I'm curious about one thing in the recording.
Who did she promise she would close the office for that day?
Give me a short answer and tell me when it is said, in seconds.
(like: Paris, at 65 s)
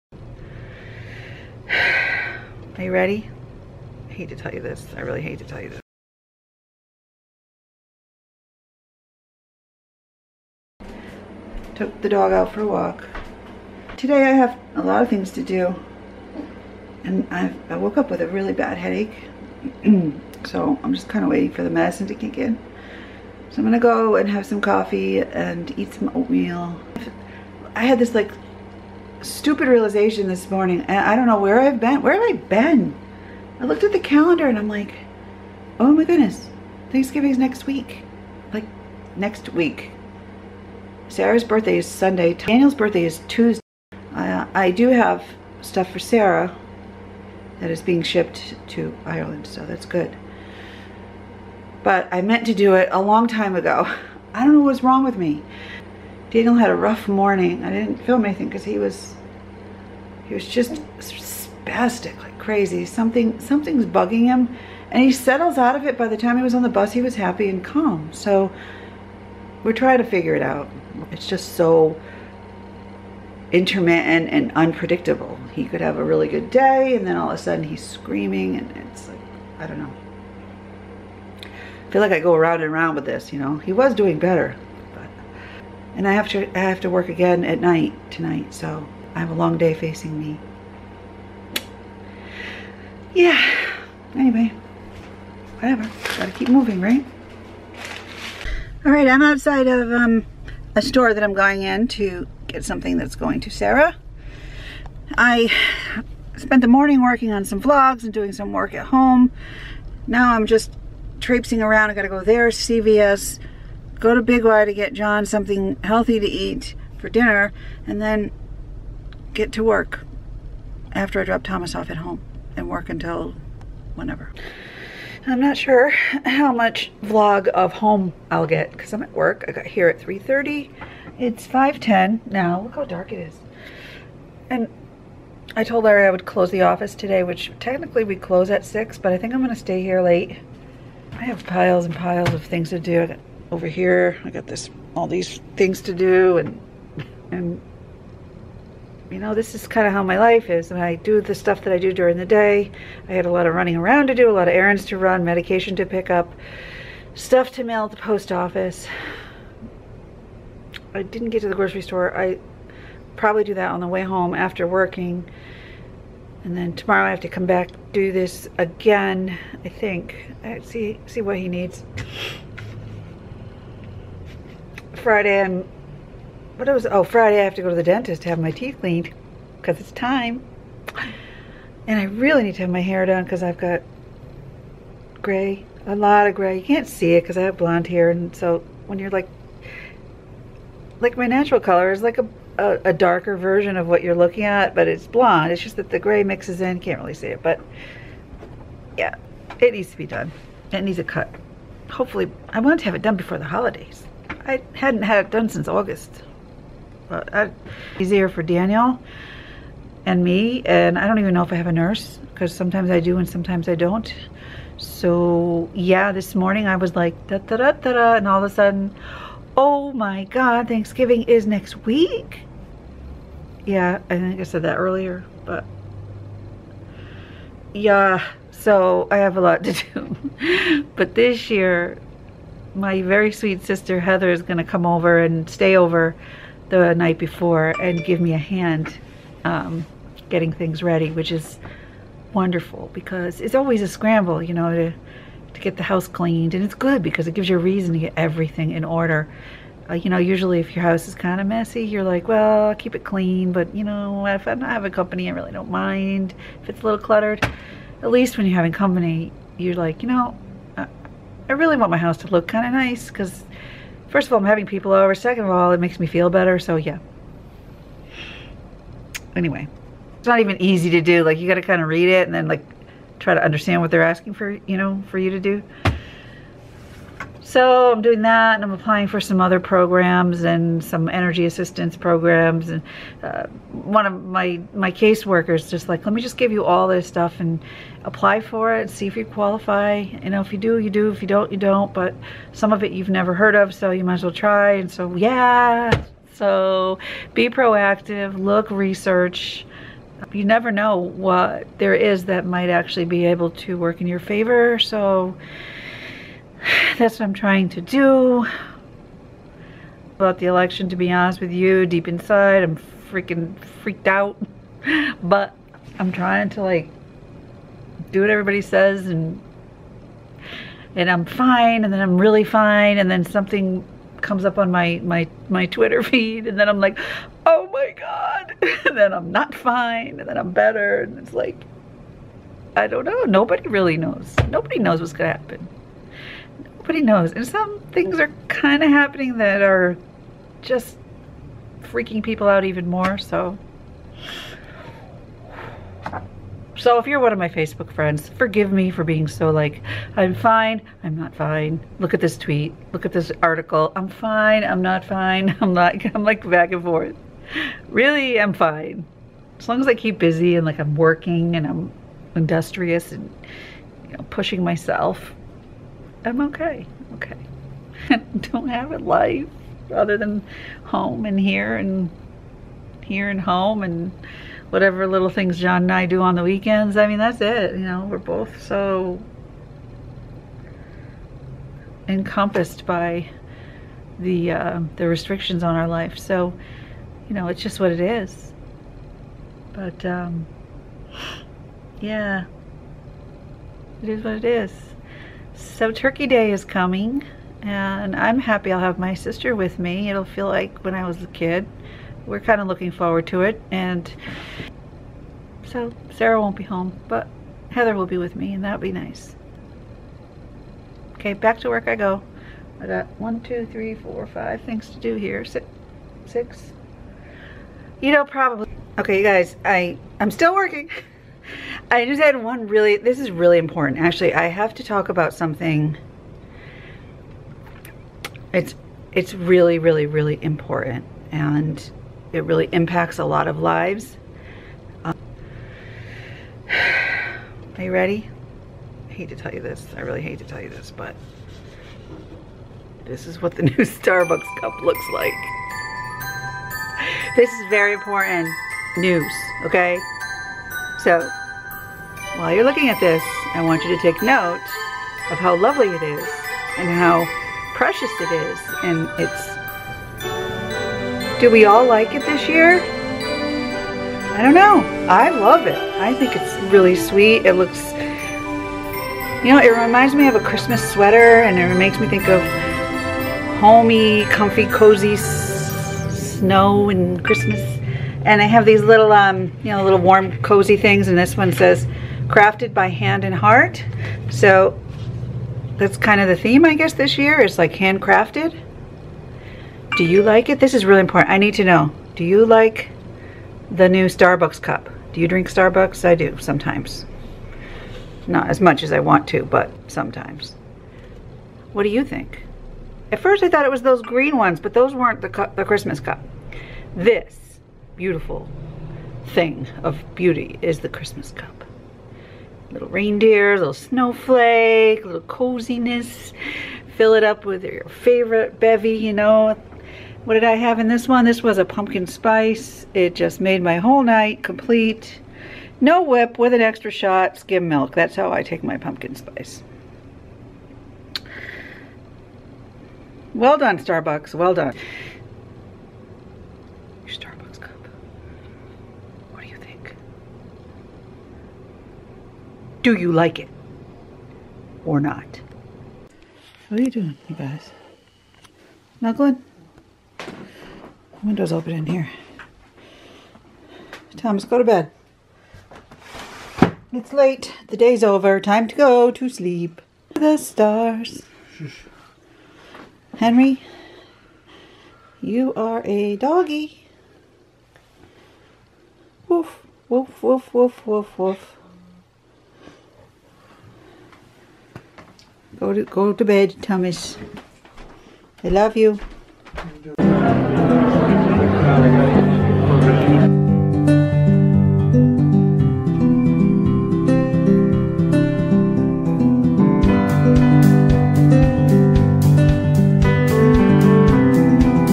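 Larry, at 135 s.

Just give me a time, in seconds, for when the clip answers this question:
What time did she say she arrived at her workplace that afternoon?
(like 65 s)
129 s.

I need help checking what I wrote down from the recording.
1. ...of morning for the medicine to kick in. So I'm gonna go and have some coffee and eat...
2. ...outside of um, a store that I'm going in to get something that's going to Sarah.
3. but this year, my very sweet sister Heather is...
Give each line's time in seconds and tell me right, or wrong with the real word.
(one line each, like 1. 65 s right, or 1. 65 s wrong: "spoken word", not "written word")
1. 21 s wrong: "waiting", not "morning"
2. 99 s right
3. 230 s right.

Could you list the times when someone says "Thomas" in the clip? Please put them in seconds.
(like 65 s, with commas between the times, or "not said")
121 s, 554 s, 576 s.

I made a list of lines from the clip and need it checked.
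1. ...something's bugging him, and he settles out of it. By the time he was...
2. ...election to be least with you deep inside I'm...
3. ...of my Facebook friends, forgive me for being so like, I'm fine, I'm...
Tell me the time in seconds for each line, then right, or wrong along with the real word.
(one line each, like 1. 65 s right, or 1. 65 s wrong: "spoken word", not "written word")
1. 63 s right
2. 310 s wrong: "honest", not "least"
3. 347 s right.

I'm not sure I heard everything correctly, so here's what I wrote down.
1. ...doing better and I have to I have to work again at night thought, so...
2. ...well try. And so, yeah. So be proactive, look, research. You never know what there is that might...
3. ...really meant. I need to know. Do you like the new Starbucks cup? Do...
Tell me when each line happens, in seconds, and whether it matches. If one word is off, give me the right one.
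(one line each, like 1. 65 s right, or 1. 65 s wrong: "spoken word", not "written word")
1. 83 s wrong: "tonight", not "thought"
2. 294 s right
3. 490 s wrong: "important", not "meant".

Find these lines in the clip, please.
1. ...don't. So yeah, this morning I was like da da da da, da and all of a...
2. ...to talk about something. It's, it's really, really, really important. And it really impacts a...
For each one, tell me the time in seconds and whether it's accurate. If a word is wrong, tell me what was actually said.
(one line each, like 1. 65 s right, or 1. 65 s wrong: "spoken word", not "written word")
1. 213 s right
2. 424 s right.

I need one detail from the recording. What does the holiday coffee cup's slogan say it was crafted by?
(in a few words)
Hand and heart.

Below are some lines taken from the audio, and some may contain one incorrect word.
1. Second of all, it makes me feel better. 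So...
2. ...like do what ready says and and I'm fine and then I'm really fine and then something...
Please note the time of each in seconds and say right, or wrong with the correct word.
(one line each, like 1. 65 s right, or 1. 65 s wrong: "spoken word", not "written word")
1. 265 s right
2. 316 s wrong: "everybody", not "ready".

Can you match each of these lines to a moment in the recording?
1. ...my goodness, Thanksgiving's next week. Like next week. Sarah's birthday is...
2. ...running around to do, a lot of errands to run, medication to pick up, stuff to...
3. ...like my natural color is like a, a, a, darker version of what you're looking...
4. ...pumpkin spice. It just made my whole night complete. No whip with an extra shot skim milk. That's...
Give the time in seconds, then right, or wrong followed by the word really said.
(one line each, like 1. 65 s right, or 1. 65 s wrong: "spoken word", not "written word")
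1. 35 s right
2. 153 s right
3. 190 s right
4. 521 s right.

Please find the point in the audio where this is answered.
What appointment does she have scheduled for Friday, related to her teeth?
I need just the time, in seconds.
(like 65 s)
177 s.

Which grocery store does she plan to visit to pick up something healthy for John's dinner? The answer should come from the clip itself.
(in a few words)
Big Y.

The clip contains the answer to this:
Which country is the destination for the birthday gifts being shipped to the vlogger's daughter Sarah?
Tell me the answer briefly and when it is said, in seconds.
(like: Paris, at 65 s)
Ireland, at 49 s.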